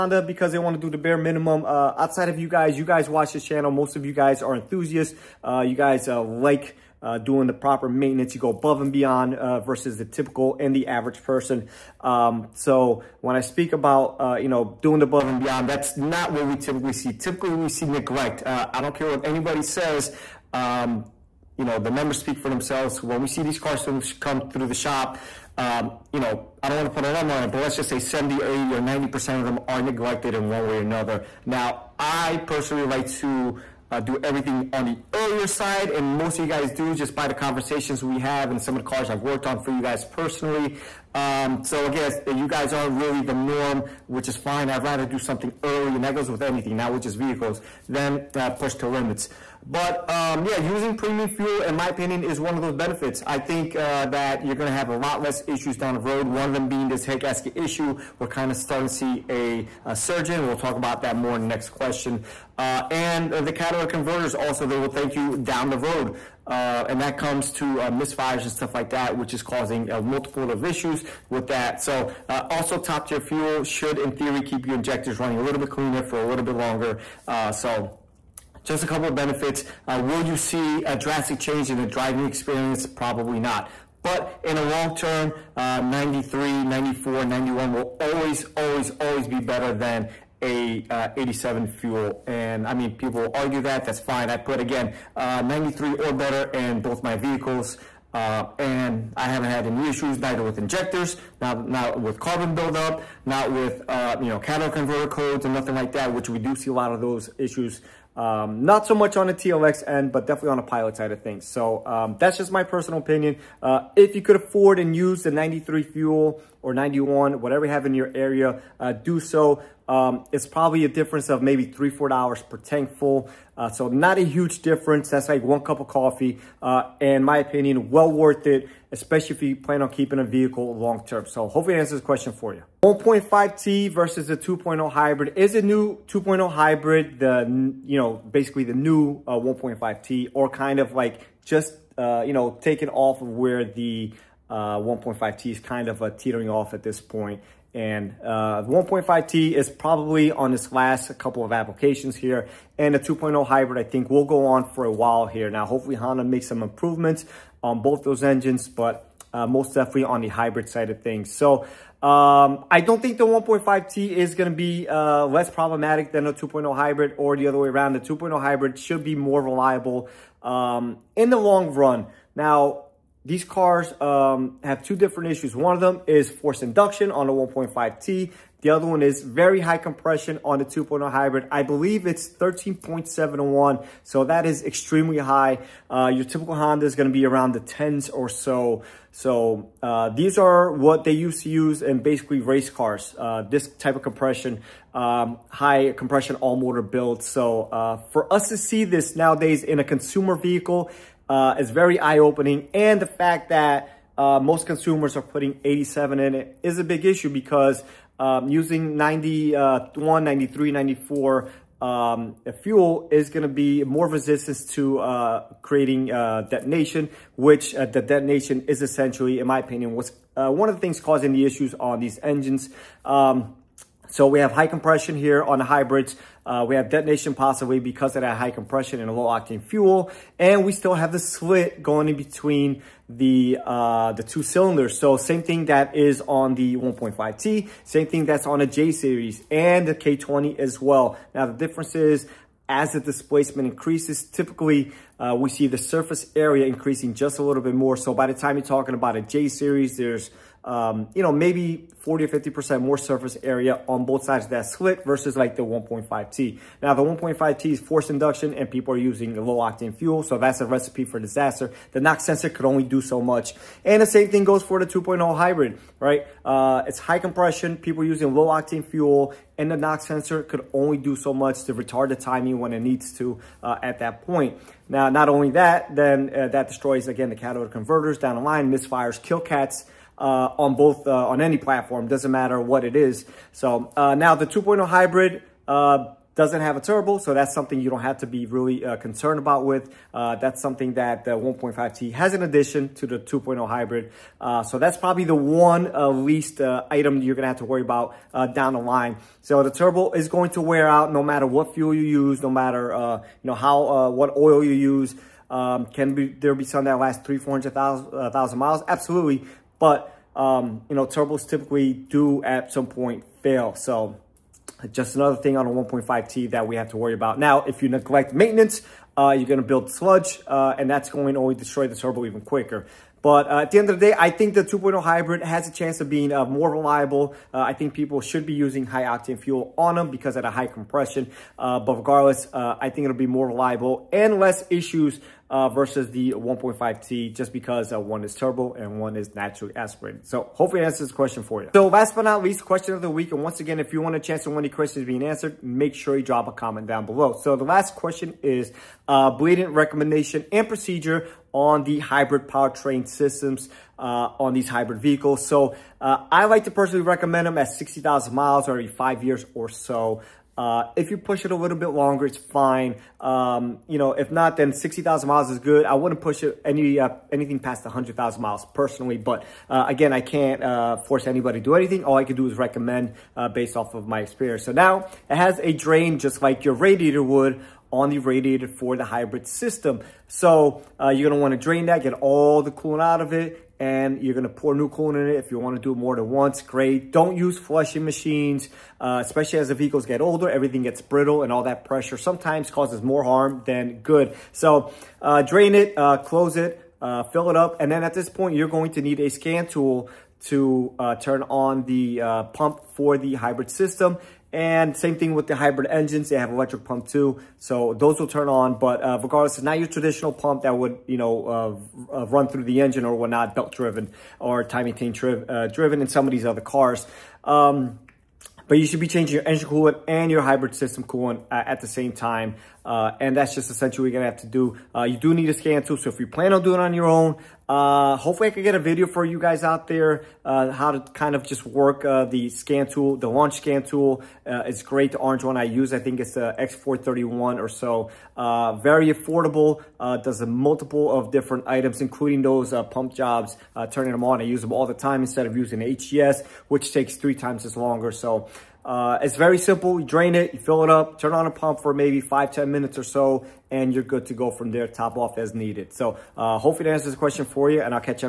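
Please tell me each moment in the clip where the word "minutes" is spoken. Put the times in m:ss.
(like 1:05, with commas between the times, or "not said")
7:32.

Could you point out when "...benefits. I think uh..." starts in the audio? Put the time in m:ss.
0:52.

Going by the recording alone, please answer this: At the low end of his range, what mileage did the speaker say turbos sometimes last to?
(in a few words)
300,000 miles.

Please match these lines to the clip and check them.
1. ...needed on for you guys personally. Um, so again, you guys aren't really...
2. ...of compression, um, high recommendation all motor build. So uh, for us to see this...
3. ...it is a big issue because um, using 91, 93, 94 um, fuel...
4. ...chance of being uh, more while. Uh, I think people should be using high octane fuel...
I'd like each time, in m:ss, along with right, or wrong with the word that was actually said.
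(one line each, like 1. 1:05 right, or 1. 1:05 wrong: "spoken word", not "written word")
1. 0:39 wrong: "worked", not "needed"
2. 3:13 wrong: "compression", not "recommendation"
3. 3:26 right
4. 5:25 wrong: "reliable", not "while".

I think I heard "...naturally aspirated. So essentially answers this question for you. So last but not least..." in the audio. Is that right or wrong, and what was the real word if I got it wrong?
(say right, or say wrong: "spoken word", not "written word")
wrong: "hopefully", not "essentially".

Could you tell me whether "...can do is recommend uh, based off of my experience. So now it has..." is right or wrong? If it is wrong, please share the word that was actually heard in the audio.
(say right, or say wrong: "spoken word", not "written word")
right.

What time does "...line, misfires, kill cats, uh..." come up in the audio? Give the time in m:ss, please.
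4:38.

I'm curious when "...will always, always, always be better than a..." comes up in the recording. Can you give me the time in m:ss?
1:27.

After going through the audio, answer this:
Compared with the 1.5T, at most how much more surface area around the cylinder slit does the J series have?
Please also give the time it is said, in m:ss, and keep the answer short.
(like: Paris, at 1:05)
50%, at 4:12.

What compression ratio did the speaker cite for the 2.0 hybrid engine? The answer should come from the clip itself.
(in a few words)
13.7 to 1.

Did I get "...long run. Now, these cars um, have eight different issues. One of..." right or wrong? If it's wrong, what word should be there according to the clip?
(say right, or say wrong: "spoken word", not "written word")
wrong: "two", not "eight".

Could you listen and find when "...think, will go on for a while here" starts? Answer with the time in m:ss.
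2:33.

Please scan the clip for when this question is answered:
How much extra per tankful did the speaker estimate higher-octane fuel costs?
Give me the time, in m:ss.
2:01.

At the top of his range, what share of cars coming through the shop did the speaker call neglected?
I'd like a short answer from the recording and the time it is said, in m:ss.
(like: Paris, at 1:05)
90%, at 0:28.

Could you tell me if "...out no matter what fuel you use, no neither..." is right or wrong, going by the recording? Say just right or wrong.
wrong.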